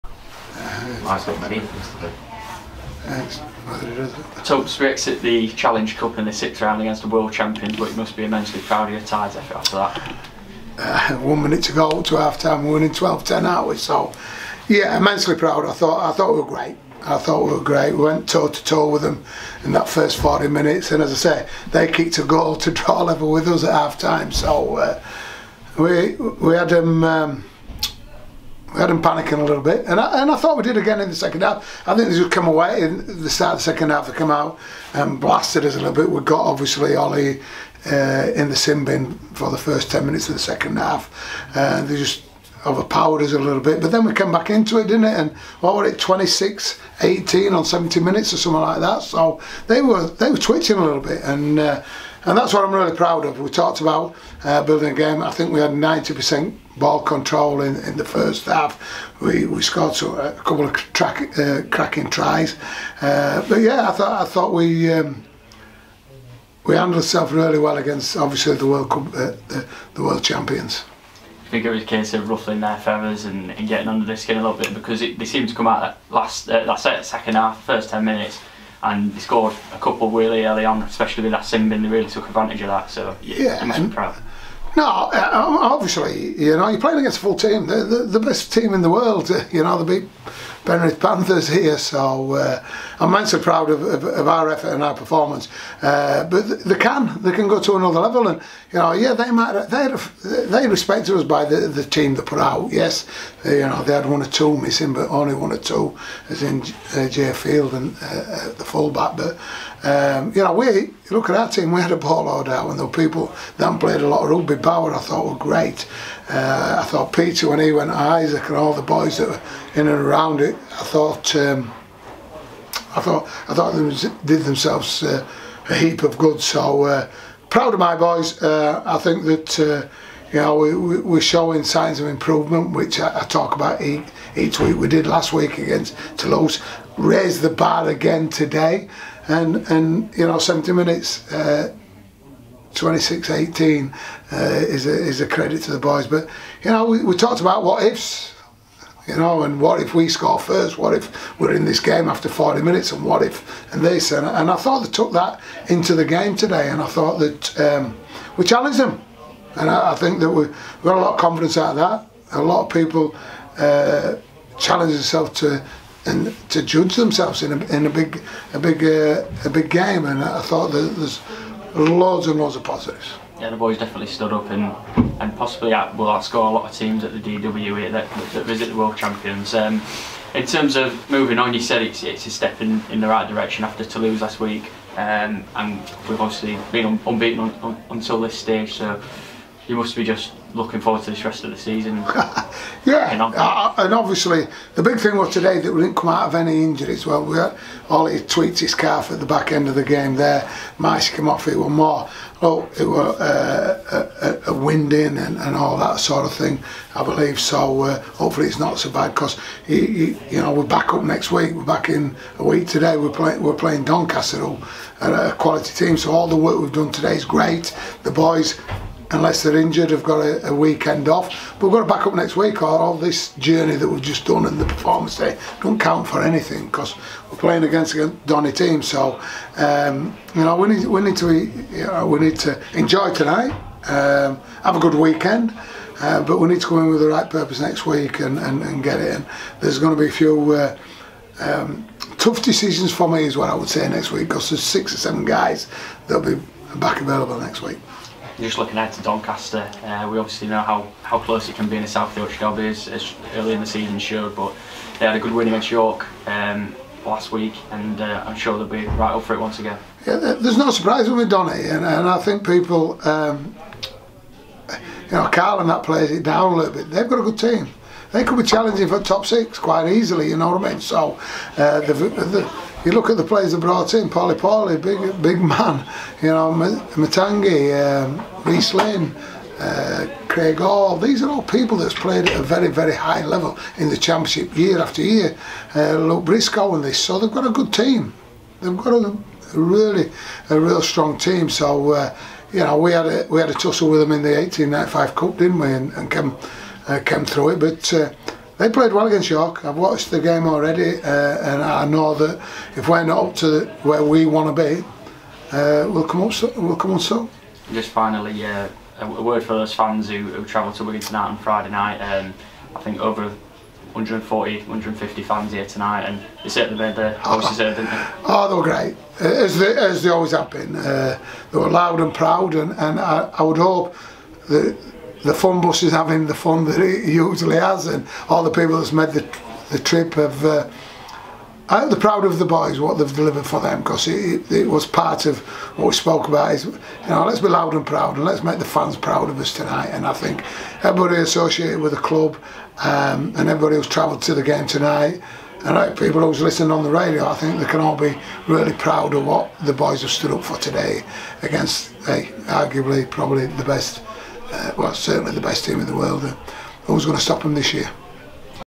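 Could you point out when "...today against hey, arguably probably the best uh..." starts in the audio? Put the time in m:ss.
5:50.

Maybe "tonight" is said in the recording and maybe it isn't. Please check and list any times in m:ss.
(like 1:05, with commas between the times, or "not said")
3:53, 5:11, 5:15, 5:39, 5:44.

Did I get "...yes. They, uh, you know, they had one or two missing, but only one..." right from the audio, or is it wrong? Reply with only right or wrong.
right.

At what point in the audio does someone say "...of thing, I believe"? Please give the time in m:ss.
3:26.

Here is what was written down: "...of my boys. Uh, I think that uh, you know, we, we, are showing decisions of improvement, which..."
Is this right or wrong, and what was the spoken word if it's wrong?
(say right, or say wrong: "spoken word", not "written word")
wrong: "signs", not "decisions".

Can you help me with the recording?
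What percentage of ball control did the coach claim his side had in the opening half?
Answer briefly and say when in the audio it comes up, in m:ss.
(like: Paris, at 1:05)
90%, at 0:55.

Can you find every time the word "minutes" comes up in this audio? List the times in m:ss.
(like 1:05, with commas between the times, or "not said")
0:11, 0:20, 0:40, 0:47, 1:18, 2:20, 2:32.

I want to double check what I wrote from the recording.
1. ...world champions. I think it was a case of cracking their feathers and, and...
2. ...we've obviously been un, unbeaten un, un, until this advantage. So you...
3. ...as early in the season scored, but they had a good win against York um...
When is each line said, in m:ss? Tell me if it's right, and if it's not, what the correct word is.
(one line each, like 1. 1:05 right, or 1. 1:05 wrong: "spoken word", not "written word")
1. 1:10 wrong: "ruffling", not "cracking"
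2. 3:06 wrong: "stage", not "advantage"
3. 4:12 wrong: "showed", not "scored".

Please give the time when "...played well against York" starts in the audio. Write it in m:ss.
4:58.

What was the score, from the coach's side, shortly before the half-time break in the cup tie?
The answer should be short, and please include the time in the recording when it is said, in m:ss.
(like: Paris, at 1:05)
12-10, at 0:12.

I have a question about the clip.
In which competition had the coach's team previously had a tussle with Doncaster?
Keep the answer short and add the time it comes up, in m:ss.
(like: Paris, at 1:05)
1895 Cup, at 4:54.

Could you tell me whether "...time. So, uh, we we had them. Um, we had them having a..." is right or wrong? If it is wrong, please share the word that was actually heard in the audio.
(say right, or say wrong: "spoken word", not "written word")
wrong: "panicking", not "having".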